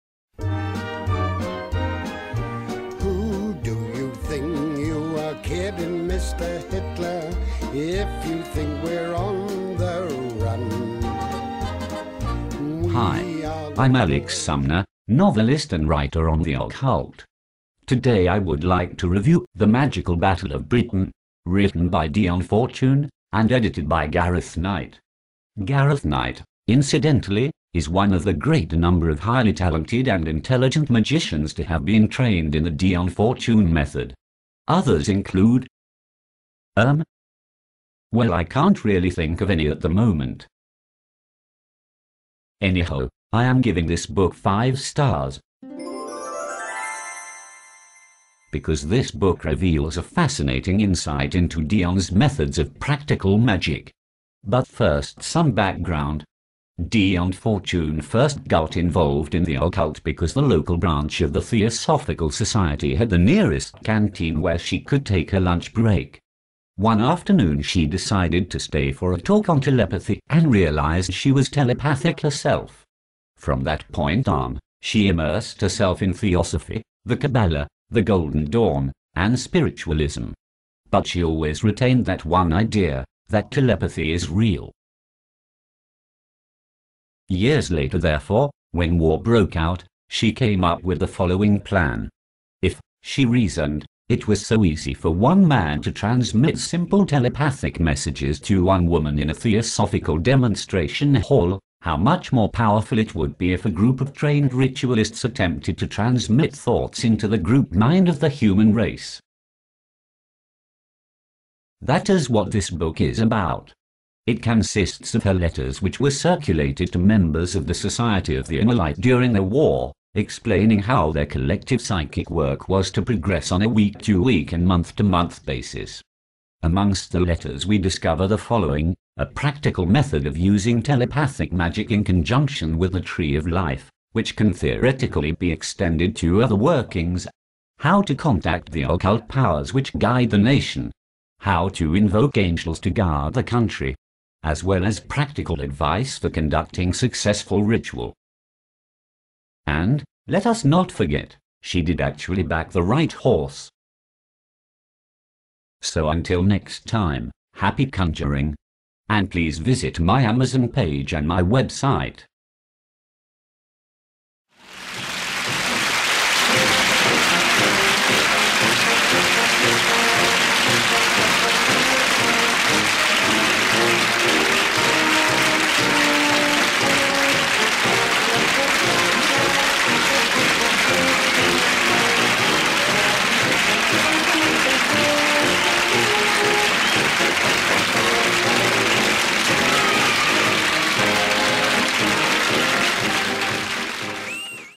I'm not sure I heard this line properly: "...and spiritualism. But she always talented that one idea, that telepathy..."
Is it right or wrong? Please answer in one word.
wrong.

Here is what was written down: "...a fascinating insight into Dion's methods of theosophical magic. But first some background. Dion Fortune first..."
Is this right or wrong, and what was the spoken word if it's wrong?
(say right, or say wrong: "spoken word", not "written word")
wrong: "practical", not "theosophical".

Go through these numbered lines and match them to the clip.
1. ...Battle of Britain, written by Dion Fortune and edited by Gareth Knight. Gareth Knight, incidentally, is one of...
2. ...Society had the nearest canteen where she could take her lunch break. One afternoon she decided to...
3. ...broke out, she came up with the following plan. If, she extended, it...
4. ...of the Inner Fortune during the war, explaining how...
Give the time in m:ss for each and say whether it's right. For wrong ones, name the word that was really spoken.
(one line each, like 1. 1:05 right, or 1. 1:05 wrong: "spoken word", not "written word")
1. 0:20 right
2. 1:02 right
3. 1:29 wrong: "reasoned", not "extended"
4. 1:58 wrong: "Light", not "Fortune".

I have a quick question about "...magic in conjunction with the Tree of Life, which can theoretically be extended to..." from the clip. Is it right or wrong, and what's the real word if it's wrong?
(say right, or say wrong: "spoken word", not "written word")
right.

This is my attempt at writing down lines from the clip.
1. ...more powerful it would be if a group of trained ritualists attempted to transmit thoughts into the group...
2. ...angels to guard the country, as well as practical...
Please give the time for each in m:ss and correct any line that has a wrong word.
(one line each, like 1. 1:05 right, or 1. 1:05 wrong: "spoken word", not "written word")
1. 1:42 right
2. 2:22 right.